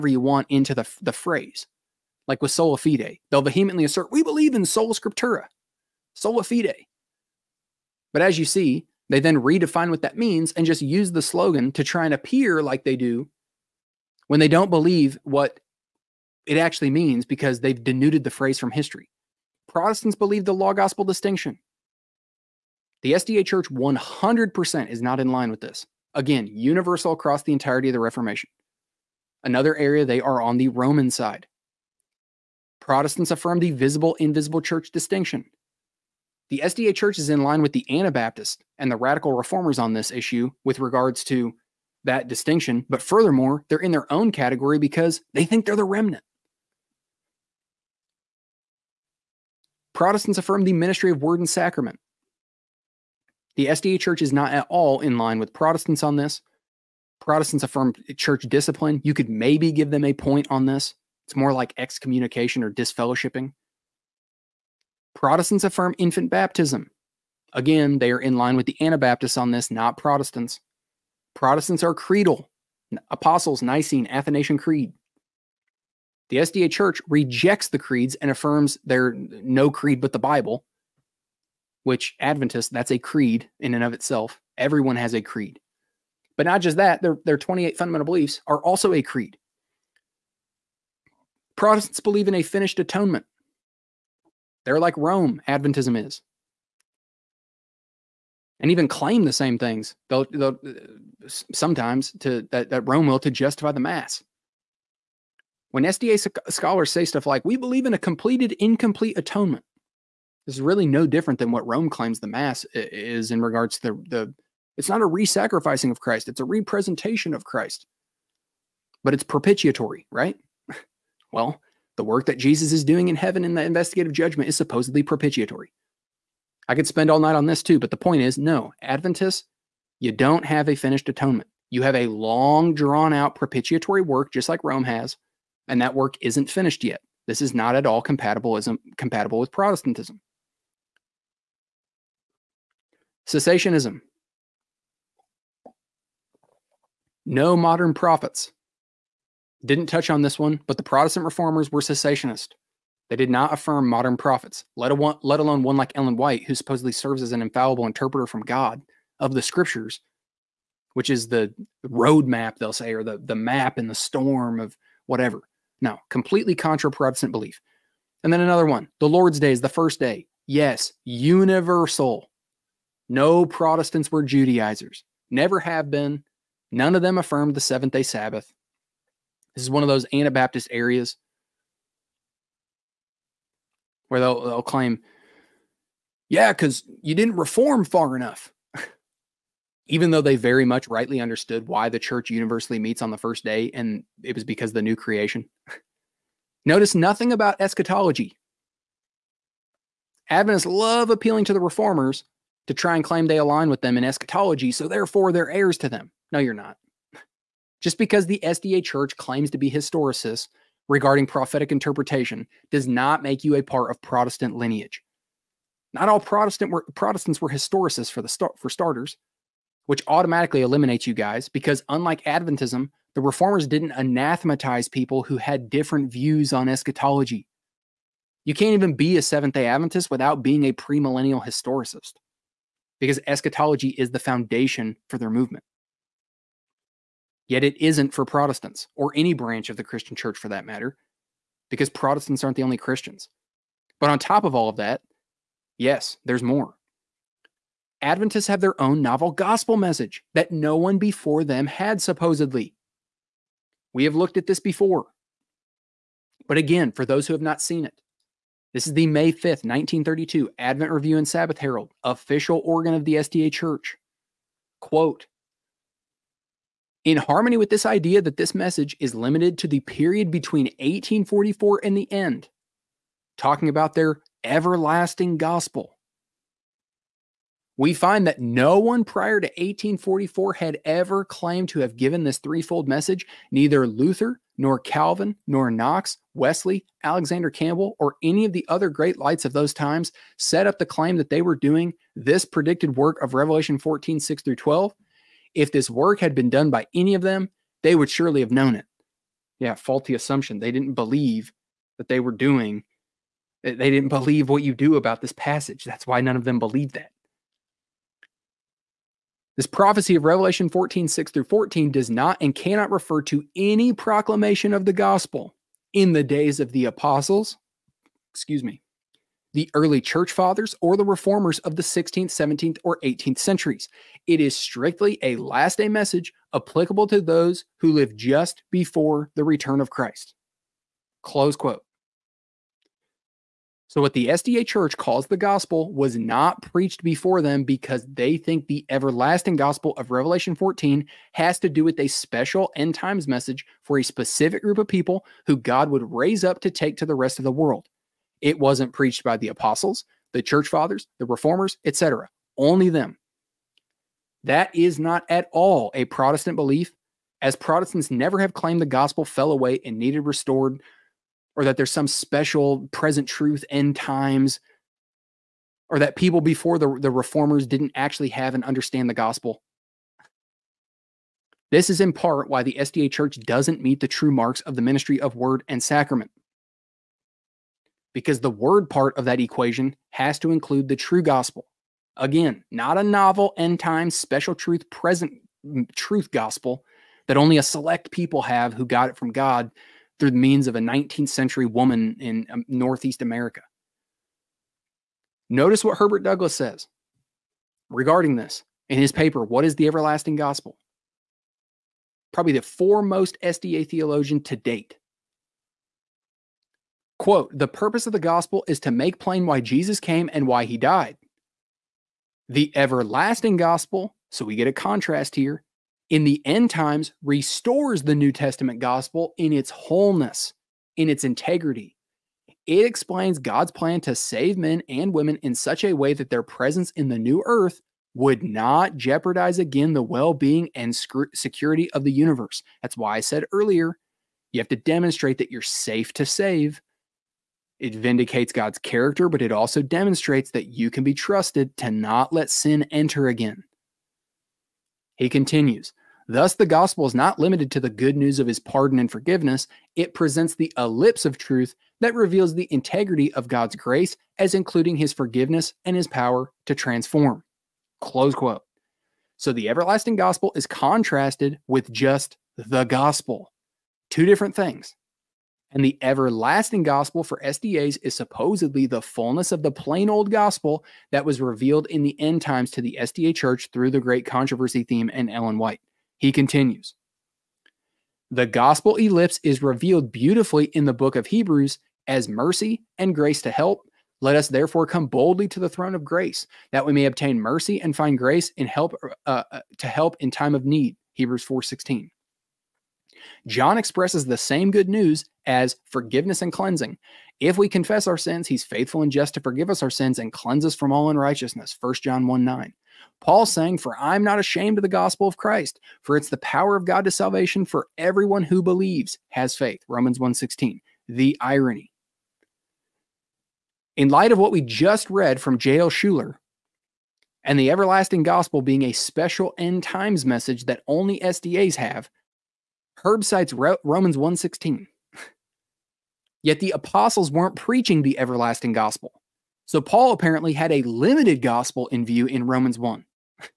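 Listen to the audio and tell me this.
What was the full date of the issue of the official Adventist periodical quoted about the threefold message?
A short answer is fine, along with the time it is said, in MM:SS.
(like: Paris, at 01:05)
May 5, 1932, at 04:19.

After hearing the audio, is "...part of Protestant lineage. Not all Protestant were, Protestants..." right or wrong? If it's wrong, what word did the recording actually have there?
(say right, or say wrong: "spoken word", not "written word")
right.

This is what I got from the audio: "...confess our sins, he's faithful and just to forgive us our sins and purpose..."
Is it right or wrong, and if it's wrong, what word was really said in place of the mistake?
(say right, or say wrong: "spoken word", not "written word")
wrong: "cleanse", not "purpose".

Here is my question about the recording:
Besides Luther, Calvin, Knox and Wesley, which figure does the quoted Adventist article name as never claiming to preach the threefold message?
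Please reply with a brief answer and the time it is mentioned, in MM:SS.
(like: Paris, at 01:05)
Alexander Campbell, at 04:47.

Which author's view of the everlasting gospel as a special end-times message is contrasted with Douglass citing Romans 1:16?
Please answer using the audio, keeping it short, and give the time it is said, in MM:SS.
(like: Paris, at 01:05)
J.L. Shuler, at 08:35.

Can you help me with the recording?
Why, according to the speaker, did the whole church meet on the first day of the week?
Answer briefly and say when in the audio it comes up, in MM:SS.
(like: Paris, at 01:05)
the new creation, at 03:14.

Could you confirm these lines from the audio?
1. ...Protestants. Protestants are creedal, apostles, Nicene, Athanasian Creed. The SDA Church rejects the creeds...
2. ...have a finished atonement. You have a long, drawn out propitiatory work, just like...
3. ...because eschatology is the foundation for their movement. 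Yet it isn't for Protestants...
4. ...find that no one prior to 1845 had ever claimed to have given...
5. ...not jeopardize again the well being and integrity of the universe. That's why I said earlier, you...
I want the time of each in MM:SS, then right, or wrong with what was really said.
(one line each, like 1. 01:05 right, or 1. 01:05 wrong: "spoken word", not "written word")
1. 01:09 right
2. 02:10 right
3. 03:53 right
4. 04:37 wrong: "1844", not "1845"
5. 07:08 wrong: "security", not "integrity".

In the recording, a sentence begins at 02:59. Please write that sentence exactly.
This is one of those Anabaptist areas where they'll, they'll claim, yeah, because you didn't reform far enough.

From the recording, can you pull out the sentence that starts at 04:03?
But on top of all of that, yes, there's more.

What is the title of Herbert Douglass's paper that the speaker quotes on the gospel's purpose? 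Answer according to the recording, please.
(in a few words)
What is the Everlasting Gospel?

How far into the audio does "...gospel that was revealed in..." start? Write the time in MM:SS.
07:50.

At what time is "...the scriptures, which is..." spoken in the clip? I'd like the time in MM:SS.
02:39.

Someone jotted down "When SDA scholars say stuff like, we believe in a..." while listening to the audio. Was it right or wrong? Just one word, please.
right.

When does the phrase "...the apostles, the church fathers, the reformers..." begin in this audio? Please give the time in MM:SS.
05:49.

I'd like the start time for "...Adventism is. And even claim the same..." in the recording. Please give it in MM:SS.
01:35.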